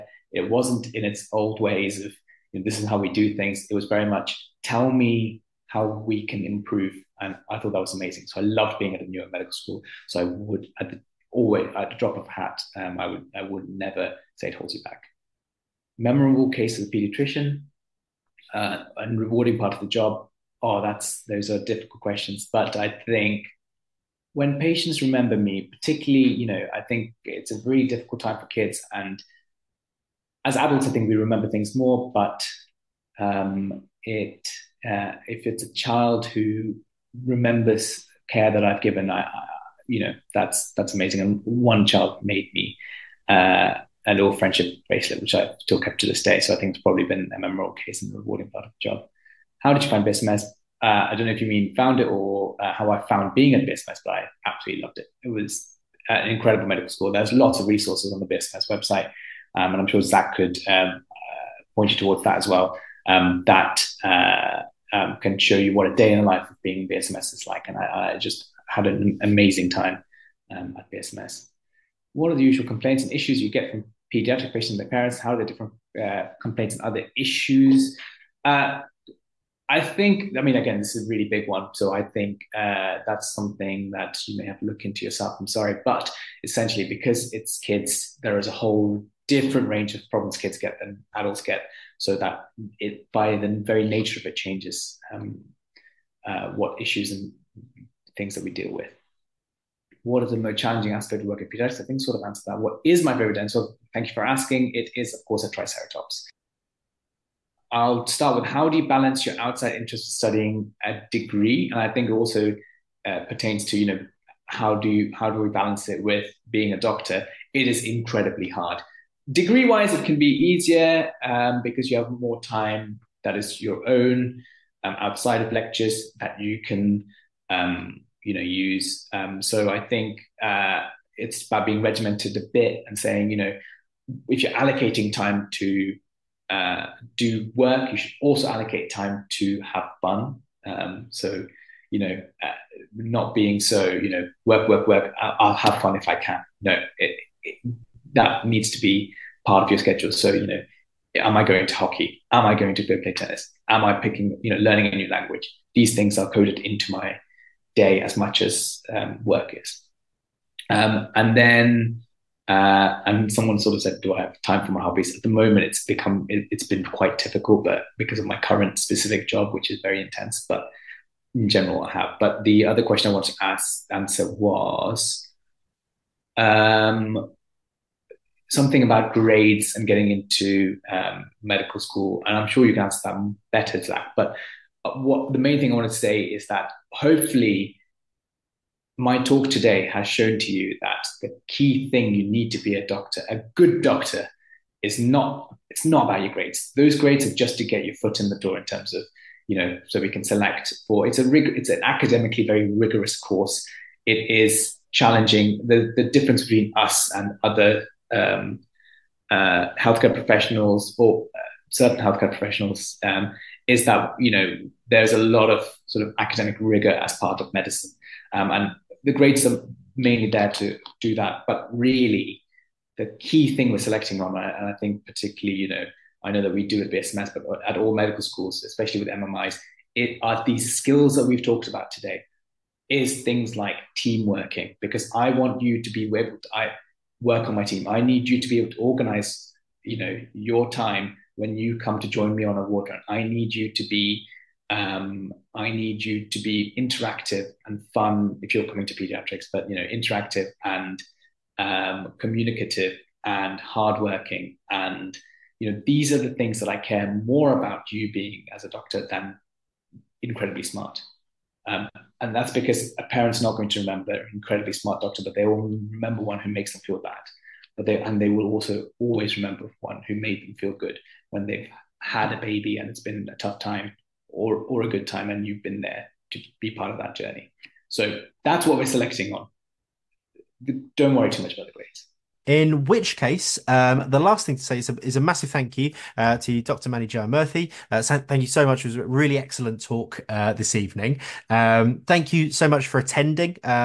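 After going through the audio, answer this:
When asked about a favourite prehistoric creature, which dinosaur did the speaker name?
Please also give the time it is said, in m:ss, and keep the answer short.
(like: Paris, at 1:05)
Triceratops, at 1:45.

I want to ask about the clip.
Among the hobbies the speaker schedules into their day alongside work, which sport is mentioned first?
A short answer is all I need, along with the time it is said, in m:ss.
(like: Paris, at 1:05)
Hockey, at 2:31.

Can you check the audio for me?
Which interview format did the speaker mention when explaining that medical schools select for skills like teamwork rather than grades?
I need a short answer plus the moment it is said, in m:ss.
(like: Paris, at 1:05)
MMIs, at 3:49.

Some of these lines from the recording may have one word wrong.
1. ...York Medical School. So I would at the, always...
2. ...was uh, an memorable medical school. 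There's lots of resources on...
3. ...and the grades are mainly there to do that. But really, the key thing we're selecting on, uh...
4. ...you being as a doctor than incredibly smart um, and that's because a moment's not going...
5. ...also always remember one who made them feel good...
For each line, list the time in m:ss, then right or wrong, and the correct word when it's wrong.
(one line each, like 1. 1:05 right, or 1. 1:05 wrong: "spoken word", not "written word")
1. 0:09 right
2. 0:55 wrong: "incredible", not "memorable"
3. 3:38 right
4. 4:17 wrong: "parent", not "moment"
5. 4:28 right.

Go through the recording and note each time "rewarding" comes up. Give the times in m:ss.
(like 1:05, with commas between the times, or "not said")
0:19, 0:48.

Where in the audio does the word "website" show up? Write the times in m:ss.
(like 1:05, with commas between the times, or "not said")
0:58.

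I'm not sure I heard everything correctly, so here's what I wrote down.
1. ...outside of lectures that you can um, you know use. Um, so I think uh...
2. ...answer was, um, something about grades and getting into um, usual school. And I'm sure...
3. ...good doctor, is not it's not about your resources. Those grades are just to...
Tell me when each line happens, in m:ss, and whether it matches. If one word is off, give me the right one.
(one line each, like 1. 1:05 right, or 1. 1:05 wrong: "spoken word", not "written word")
1. 2:04 right
2. 2:53 wrong: "medical", not "usual"
3. 3:13 wrong: "grades", not "resources".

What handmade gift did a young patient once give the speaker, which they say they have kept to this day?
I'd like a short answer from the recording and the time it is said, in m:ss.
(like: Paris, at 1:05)
Friendship bracelet, at 0:44.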